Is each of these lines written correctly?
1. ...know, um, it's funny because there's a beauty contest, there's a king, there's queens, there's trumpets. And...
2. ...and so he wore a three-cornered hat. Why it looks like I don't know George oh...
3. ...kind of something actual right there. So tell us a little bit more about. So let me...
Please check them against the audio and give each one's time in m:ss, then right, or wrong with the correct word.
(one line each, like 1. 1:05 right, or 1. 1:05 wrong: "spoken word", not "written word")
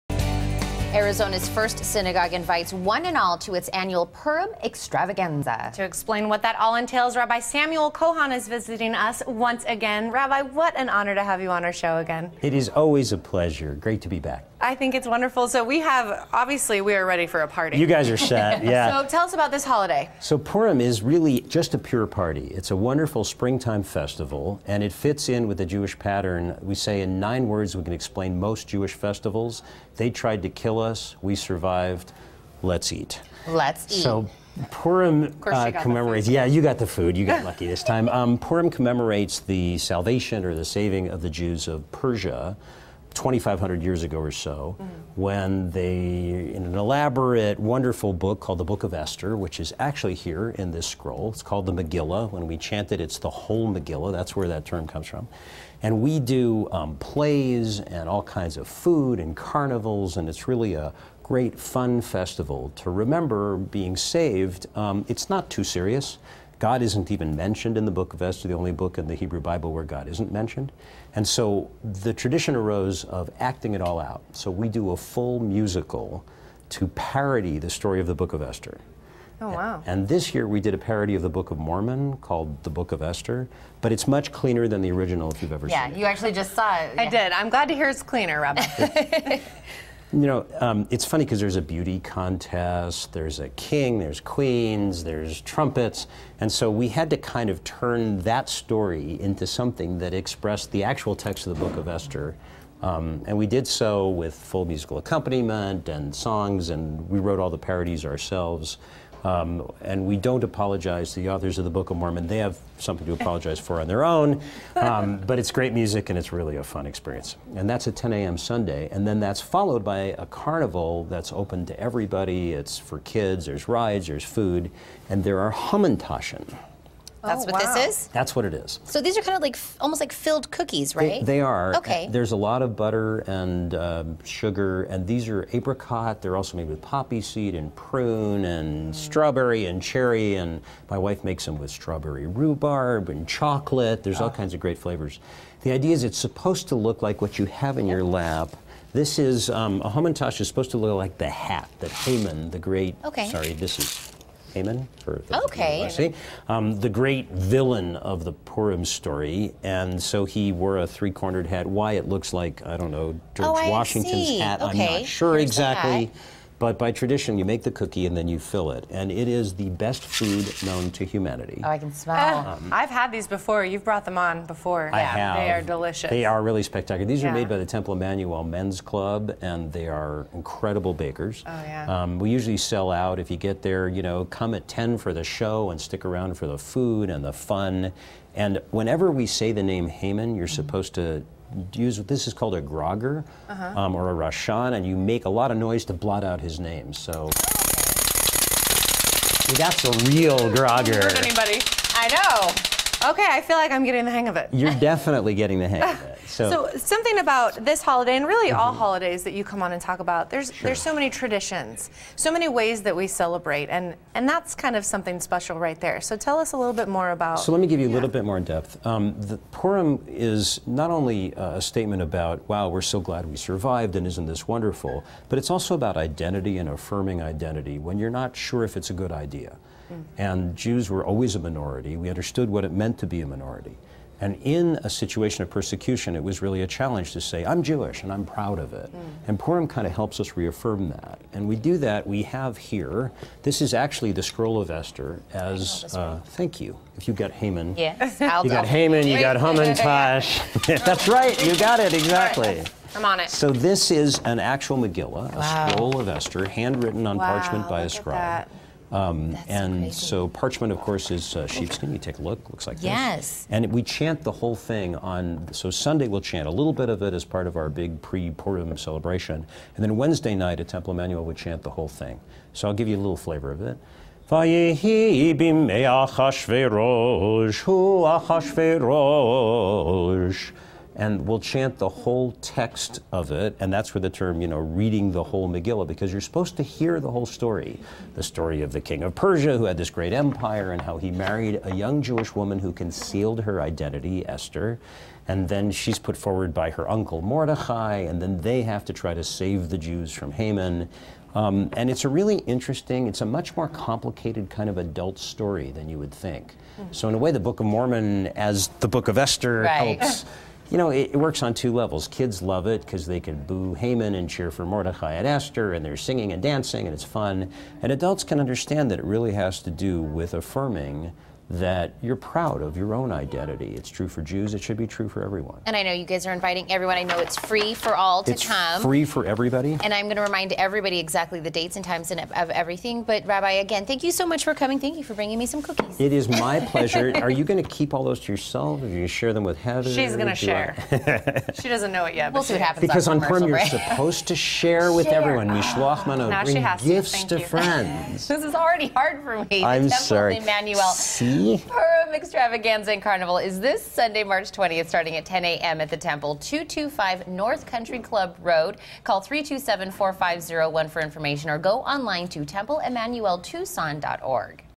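1. 1:30 right
2. 2:39 right
3. 3:34 wrong: "special", not "actual".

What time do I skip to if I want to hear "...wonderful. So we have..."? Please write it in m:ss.
0:15.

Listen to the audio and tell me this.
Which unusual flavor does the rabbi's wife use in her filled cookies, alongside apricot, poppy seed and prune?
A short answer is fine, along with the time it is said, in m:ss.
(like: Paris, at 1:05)
Strawberry rhubarb, at 2:21.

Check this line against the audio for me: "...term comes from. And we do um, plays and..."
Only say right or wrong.
right.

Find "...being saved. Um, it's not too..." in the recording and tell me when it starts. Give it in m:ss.
1:03.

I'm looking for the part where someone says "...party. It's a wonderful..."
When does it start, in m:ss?
0:22.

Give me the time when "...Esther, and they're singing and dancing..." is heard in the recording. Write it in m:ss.
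5:15.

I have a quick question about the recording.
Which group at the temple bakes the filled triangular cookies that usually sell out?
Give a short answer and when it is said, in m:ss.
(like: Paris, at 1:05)
Temple Emanu-El Men's Club, at 2:57.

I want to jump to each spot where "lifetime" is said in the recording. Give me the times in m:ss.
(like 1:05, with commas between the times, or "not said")
not said.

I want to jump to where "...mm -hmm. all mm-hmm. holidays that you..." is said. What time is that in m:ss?
3:28.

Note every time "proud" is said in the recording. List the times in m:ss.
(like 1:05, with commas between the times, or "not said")
3:58, 5:22.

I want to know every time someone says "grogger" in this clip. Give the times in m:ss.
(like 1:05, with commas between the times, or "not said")
3:12, 3:20.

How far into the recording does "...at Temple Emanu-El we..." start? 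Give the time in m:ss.
4:30.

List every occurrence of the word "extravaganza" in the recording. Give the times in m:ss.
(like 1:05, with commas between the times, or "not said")
0:04, 5:52.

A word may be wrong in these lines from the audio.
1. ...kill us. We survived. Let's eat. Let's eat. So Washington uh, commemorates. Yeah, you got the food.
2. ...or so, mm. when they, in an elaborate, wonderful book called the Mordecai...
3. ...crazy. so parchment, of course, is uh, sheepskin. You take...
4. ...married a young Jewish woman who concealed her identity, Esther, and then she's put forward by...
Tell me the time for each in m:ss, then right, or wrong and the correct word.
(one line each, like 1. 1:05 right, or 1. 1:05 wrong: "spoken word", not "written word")
1. 0:30 wrong: "Purim", not "Washington"
2. 0:44 wrong: "Book", not "Mordecai"
3. 4:19 right
4. 4:51 right.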